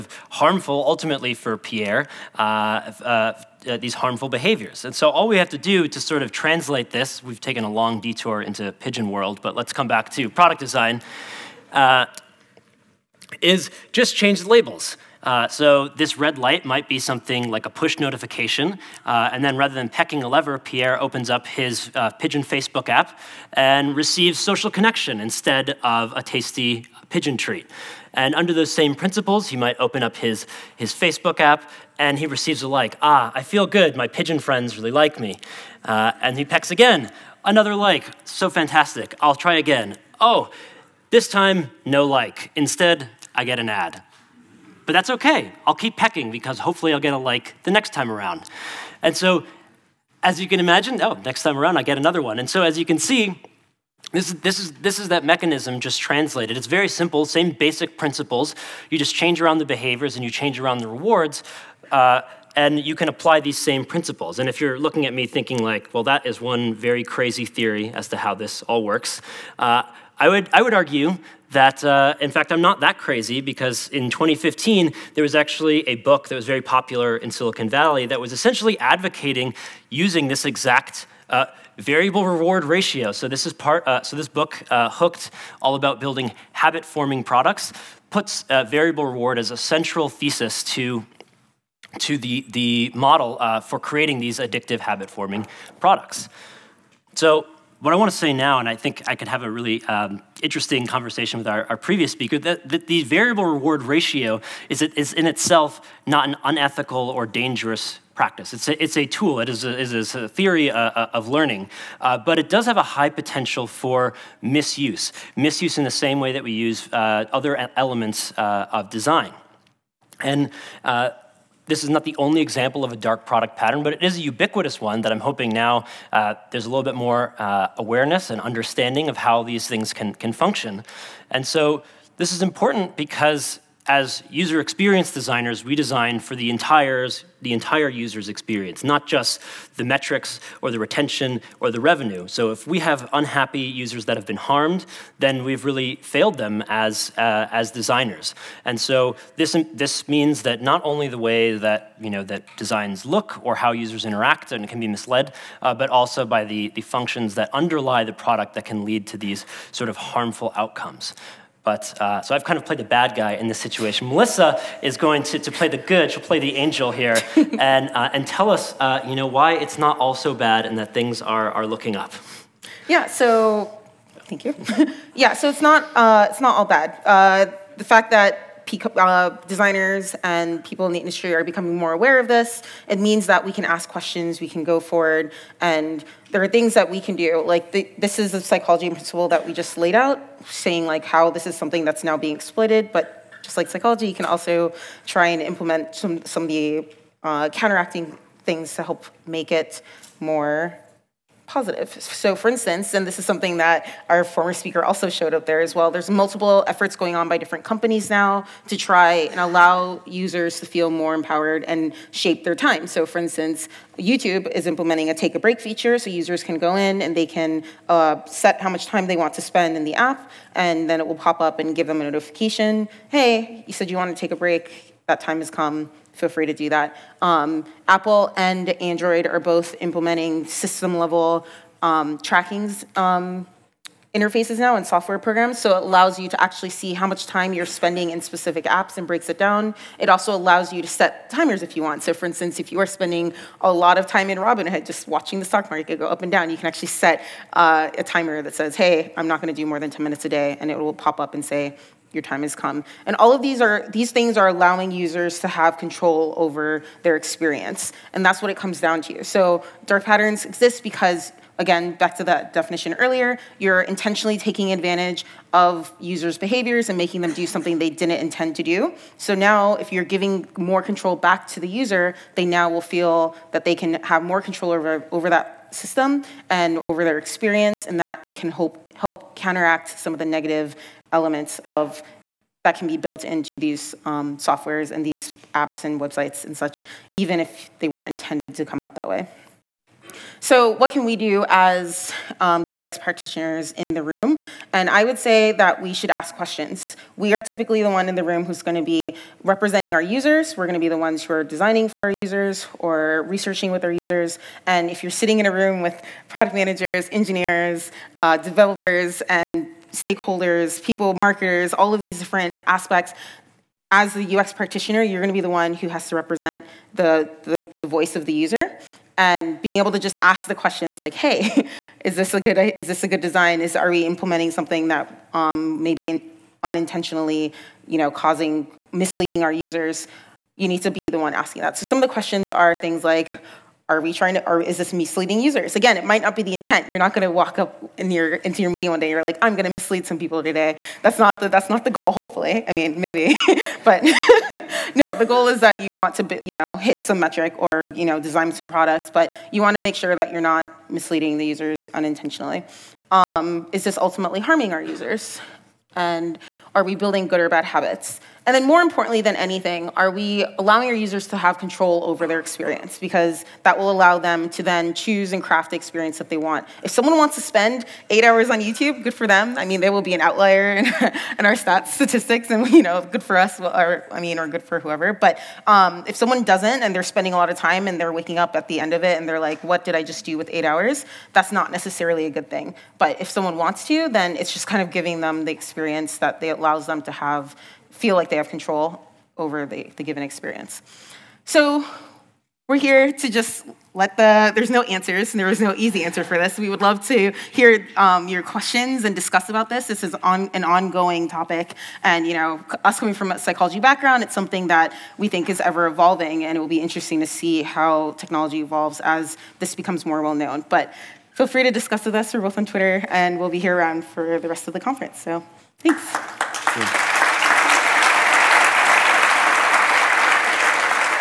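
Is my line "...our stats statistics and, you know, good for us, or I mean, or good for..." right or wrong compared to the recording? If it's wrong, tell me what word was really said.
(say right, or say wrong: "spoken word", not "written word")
right.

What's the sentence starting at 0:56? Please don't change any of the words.
It's very simple, same basic principles.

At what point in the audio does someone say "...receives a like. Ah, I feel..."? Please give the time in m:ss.
0:32.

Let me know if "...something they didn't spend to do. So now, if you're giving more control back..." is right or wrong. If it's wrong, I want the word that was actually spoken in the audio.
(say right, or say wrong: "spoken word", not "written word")
wrong: "intend", not "spend".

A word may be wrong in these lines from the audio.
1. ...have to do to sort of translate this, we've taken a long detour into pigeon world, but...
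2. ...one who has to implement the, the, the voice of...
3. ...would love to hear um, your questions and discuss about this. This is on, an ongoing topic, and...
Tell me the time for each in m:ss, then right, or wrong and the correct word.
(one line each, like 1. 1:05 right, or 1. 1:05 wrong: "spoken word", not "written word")
1. 0:05 right
2. 5:15 wrong: "represent", not "implement"
3. 6:36 right.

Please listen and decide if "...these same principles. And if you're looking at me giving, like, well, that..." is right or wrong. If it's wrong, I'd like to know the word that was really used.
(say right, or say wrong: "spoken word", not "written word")
wrong: "thinking", not "giving".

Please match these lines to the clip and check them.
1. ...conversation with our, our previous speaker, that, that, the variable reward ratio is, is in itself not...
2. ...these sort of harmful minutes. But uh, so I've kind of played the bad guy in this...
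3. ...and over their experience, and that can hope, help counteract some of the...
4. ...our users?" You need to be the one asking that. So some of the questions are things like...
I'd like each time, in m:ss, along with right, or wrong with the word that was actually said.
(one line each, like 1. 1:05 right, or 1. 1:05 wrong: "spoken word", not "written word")
1. 1:40 right
2. 2:39 wrong: "outcomes", not "minutes"
3. 4:36 right
4. 5:29 right.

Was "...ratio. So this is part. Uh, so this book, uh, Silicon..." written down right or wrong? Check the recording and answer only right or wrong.
wrong.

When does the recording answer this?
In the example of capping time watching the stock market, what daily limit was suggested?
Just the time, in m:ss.
4:09.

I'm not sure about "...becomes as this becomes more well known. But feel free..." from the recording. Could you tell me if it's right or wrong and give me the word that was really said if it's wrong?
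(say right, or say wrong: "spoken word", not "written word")
wrong: "evolves", not "becomes".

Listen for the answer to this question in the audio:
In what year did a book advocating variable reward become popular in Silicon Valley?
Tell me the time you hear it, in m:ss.
1:14.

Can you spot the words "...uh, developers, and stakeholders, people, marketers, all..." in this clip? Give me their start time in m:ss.
5:08.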